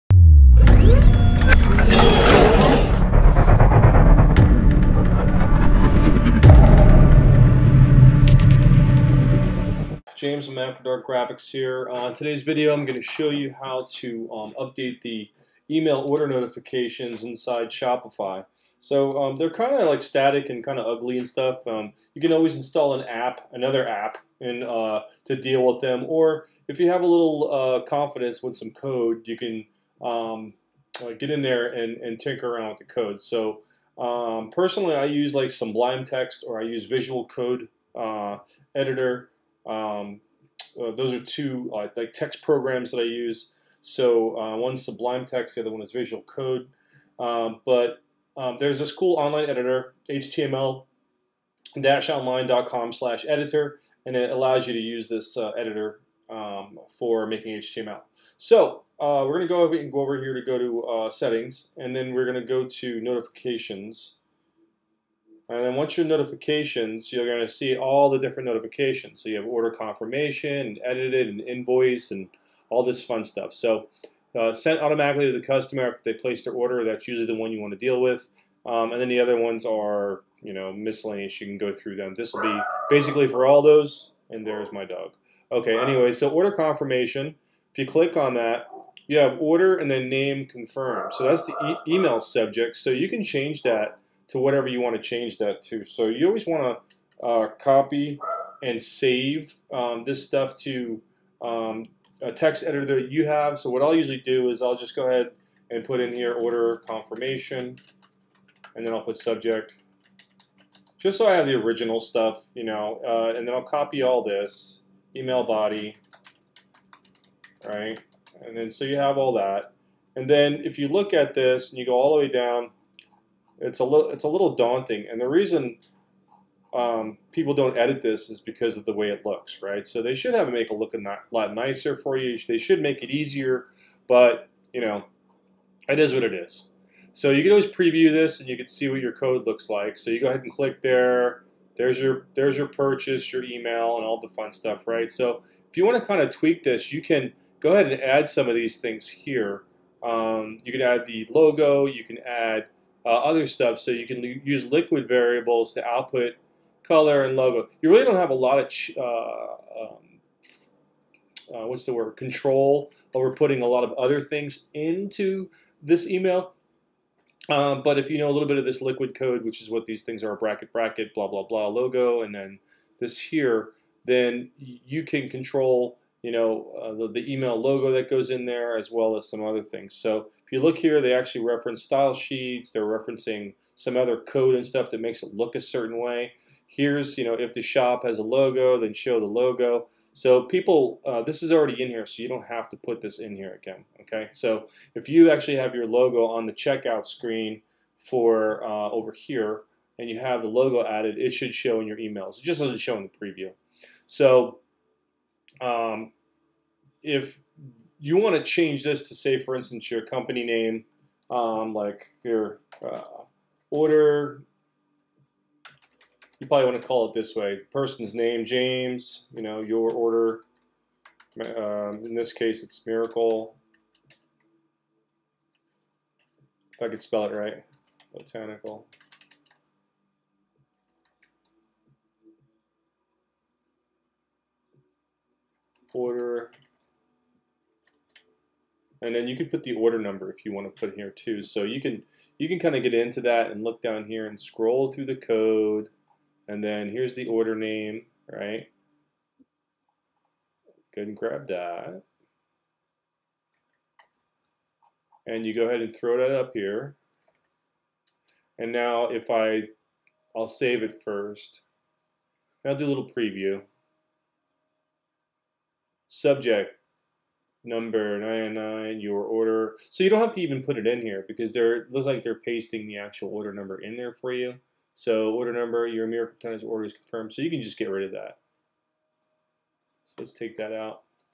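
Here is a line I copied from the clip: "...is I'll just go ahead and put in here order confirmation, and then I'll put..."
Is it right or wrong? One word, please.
right.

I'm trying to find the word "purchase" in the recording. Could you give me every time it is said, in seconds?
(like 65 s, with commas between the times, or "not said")
142 s.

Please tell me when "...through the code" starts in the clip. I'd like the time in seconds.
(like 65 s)
244 s.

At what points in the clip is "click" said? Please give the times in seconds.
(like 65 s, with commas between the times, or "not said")
87 s, 140 s.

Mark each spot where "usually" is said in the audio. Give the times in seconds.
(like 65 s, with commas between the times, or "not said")
77 s, 103 s.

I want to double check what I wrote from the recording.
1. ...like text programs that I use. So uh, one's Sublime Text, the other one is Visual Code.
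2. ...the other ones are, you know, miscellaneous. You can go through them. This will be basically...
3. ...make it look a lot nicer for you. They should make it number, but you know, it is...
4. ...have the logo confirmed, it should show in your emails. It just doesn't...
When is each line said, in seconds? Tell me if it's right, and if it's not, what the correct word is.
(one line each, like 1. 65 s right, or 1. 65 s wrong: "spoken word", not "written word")
1. 41 s right
2. 79 s right
3. 130 s wrong: "easier", not "number"
4. 200 s wrong: "added", not "confirmed".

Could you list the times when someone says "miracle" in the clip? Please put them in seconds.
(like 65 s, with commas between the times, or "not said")
222 s, 276 s.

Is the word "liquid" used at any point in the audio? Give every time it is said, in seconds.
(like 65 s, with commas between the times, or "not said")
154 s, 168 s.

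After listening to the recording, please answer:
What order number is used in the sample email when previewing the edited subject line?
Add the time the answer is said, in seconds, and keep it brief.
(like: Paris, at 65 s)
999, at 268 s.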